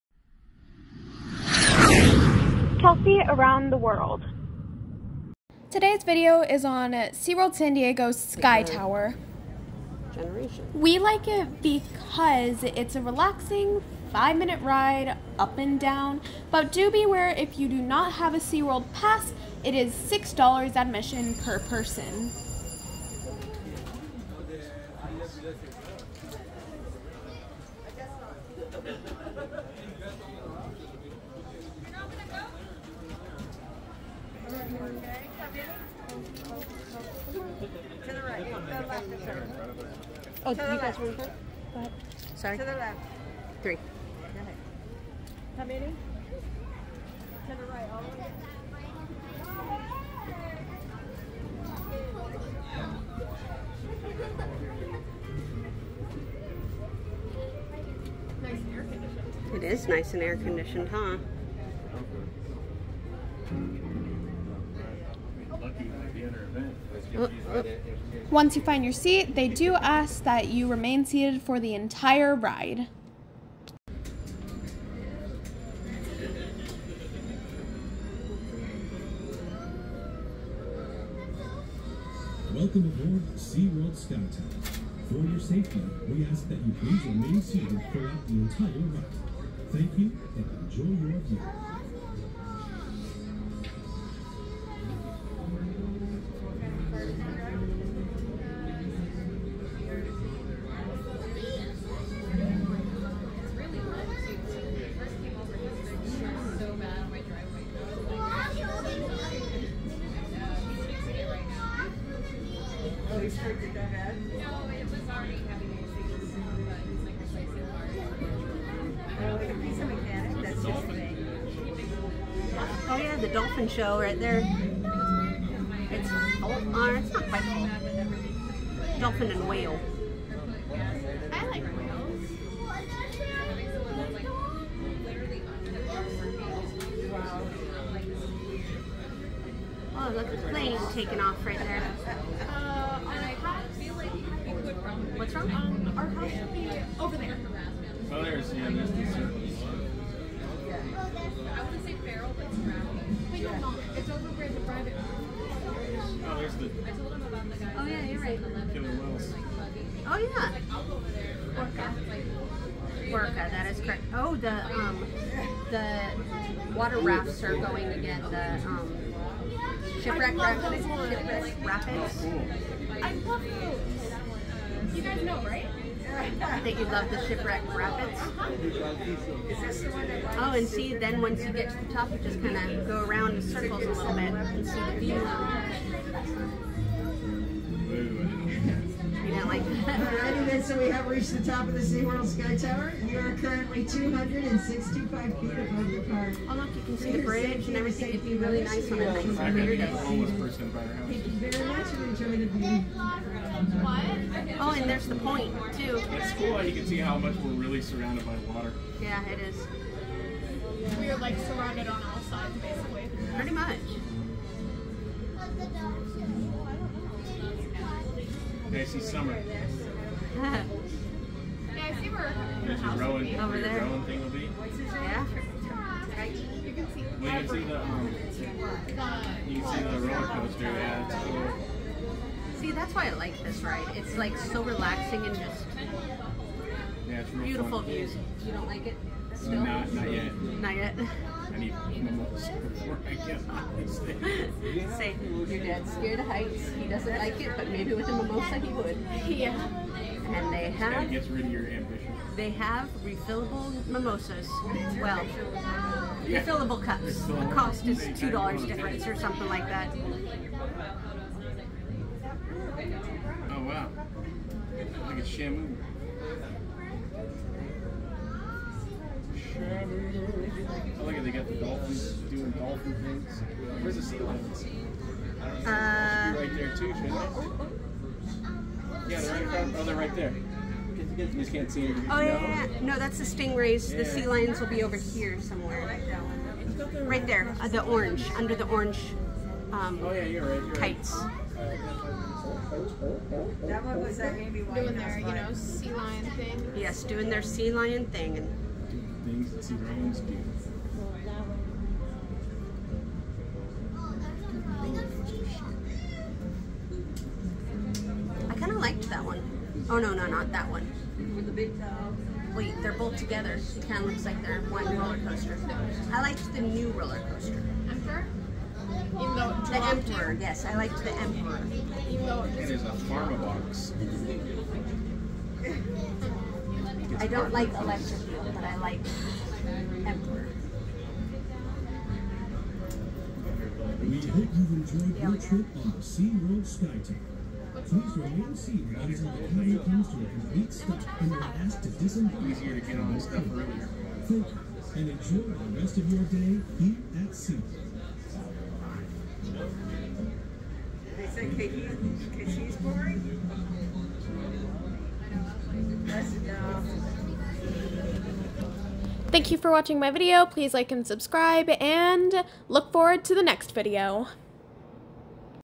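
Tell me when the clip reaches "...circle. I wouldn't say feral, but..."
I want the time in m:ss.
2:29.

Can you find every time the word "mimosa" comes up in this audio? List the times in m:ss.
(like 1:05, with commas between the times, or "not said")
4:08, 4:13.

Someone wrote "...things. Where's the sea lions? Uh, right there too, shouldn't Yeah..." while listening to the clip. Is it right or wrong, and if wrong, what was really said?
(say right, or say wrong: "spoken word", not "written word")
right.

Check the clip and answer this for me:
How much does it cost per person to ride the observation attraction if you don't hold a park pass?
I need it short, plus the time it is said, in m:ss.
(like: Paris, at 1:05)
$6, at 0:19.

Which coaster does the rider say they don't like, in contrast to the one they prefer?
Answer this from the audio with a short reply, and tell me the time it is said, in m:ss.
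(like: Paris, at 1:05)
Electric Eel, at 5:27.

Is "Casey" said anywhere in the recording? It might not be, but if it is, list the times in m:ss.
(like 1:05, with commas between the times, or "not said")
3:38.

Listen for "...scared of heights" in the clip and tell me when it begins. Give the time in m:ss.
4:05.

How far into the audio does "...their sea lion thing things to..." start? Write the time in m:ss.
4:57.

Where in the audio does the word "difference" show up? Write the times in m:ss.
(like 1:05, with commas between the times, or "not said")
4:18.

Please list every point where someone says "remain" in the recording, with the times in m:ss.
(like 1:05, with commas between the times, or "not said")
1:10, 1:27, 5:38.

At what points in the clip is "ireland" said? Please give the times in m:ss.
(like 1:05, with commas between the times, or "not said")
not said.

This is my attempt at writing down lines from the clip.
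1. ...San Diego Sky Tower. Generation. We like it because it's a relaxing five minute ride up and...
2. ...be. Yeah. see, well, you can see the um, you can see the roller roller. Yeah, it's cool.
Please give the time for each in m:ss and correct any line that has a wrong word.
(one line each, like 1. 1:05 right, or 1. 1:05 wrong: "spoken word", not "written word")
1. 0:07 right
2. 3:44 wrong: "coaster", not "roller".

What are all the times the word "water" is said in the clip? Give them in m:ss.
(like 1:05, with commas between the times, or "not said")
2:46, 3:28.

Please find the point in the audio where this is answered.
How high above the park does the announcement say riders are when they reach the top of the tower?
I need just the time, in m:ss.
3:13.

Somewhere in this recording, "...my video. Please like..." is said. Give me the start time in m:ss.
5:59.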